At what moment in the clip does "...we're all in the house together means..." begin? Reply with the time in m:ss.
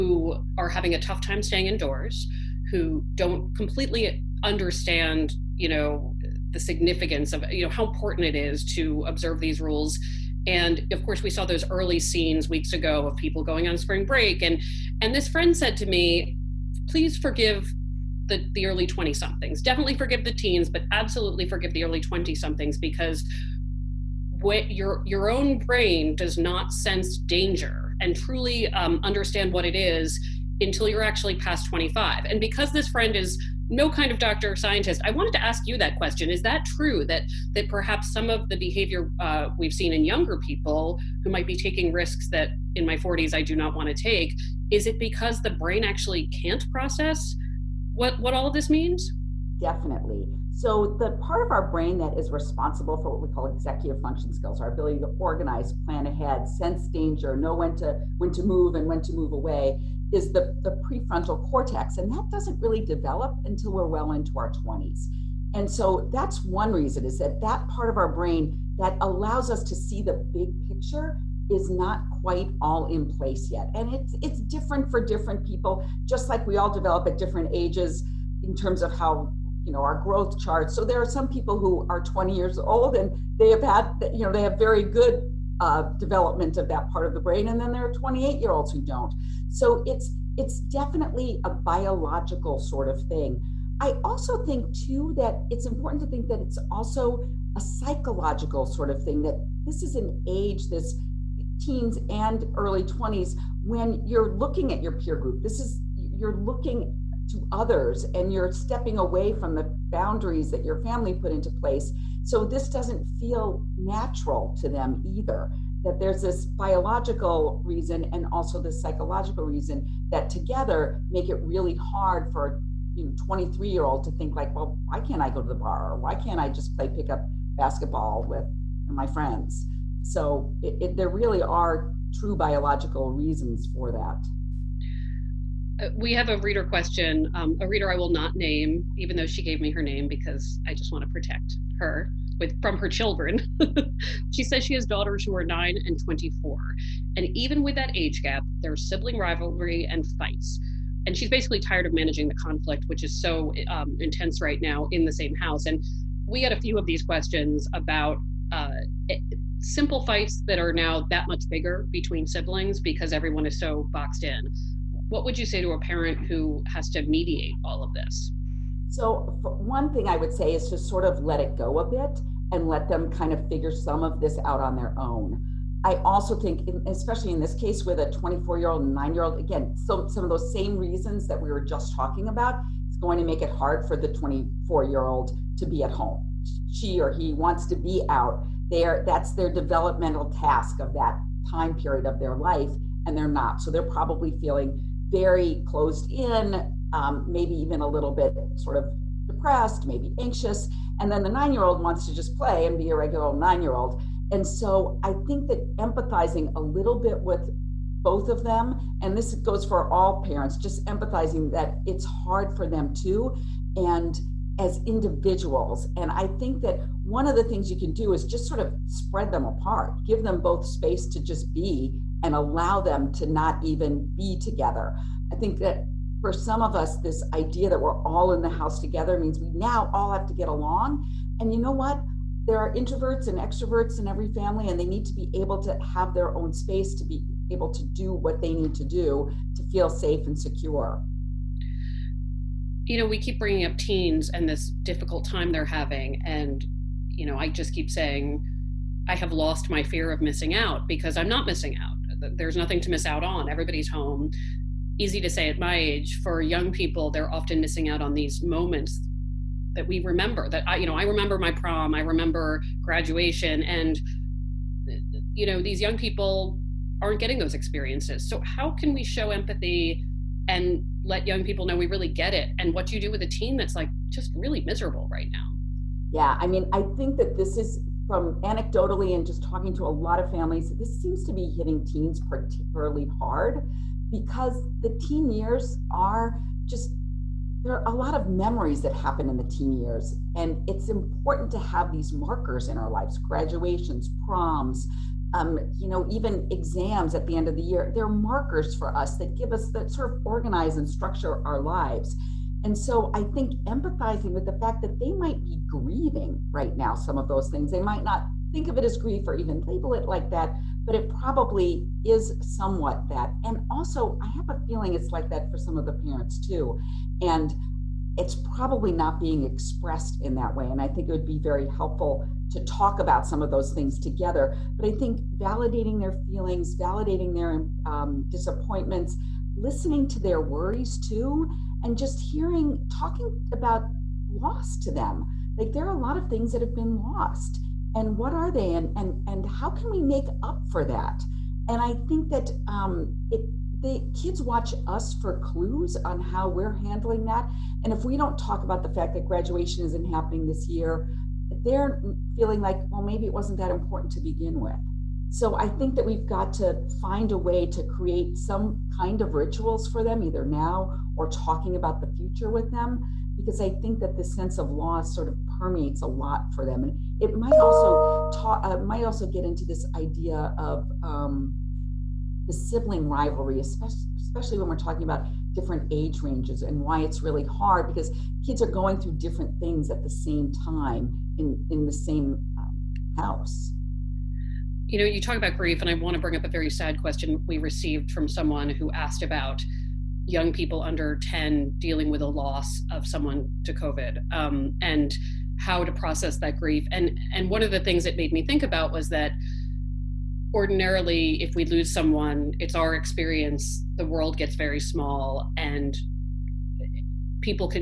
3:47.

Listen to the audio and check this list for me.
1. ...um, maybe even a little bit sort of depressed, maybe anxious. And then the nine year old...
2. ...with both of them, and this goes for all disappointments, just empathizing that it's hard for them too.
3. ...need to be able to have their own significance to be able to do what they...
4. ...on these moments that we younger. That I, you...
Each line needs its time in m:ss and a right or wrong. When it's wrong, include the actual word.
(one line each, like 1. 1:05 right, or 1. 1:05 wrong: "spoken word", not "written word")
1. 3:16 right
2. 3:27 wrong: "parents", not "disappointments"
3. 3:54 wrong: "space", not "significance"
4. 4:18 wrong: "remember", not "younger".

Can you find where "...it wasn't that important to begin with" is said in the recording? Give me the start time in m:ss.
5:53.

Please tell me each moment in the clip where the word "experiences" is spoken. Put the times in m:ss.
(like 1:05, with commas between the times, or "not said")
4:27, 6:42.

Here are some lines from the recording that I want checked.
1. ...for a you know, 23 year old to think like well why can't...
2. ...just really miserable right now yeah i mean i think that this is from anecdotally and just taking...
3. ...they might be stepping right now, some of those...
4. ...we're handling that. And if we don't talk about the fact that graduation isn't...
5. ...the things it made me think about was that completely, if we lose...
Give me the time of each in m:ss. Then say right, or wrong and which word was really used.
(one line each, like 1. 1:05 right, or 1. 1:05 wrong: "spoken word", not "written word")
1. 2:02 right
2. 4:34 wrong: "talking", not "taking"
3. 5:04 wrong: "grieving", not "stepping"
4. 5:46 right
5. 6:37 wrong: "ordinarily", not "completely".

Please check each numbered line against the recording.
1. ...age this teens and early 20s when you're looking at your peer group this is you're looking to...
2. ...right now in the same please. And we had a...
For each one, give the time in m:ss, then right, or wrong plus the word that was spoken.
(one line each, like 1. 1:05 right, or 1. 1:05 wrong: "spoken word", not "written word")
1. 1:40 right
2. 2:34 wrong: "house", not "please".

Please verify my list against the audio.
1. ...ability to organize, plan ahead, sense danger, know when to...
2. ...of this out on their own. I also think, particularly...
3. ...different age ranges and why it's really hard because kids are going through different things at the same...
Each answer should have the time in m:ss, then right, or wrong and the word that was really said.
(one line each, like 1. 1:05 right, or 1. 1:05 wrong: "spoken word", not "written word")
1. 0:54 right
2. 2:54 wrong: "especially", not "particularly"
3. 6:15 right.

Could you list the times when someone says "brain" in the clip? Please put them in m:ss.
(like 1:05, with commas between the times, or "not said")
0:25, 0:45, 0:51, 1:08, 1:27.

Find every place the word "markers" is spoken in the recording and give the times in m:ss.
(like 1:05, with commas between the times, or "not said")
4:52, 4:58.